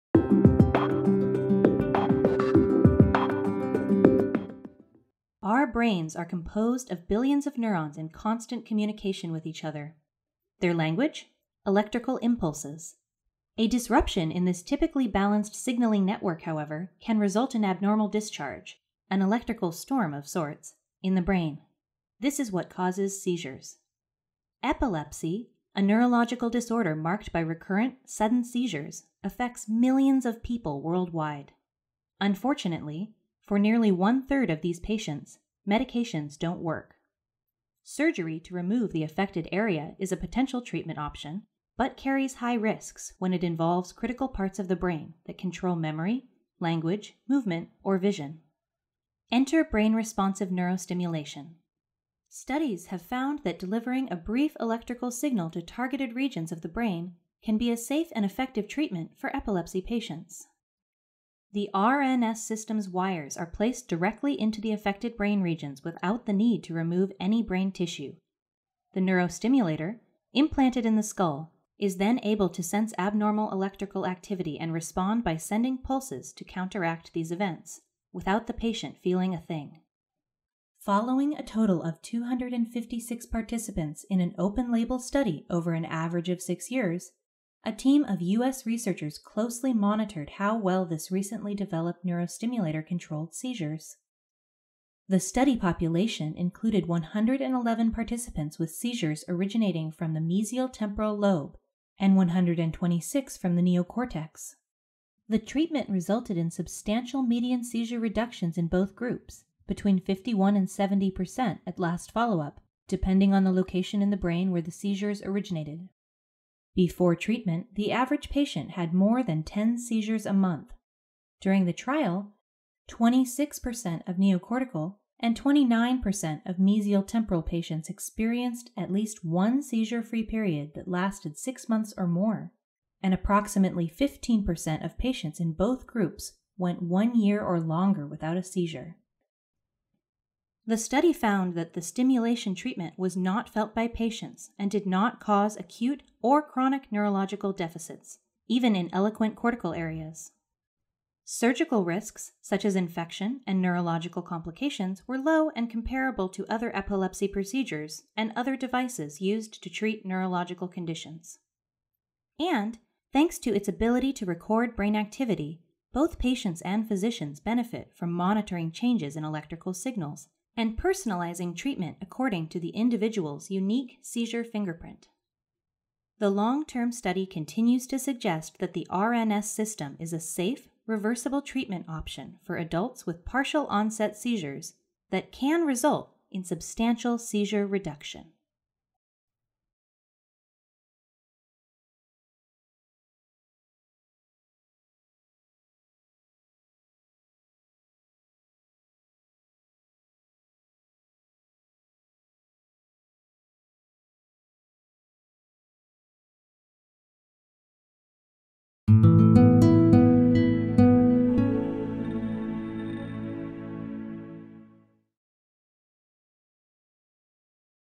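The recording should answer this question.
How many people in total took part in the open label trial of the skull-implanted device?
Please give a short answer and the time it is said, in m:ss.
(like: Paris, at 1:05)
256, at 1:22.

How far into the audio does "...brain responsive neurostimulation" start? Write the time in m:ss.
0:49.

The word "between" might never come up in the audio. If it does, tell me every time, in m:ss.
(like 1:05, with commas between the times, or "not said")
1:49.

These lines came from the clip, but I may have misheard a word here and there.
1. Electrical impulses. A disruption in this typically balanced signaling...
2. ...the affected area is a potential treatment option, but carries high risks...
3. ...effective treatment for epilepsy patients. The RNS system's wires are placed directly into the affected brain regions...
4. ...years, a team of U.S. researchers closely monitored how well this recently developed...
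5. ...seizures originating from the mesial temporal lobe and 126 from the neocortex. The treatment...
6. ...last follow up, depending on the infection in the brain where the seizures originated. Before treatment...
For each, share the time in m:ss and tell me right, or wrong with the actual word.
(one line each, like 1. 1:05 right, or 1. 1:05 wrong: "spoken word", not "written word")
1. 0:11 right
2. 0:38 right
3. 0:58 right
4. 1:26 right
5. 1:38 right
6. 1:51 wrong: "location", not "infection".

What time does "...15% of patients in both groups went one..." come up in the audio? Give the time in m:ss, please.
2:13.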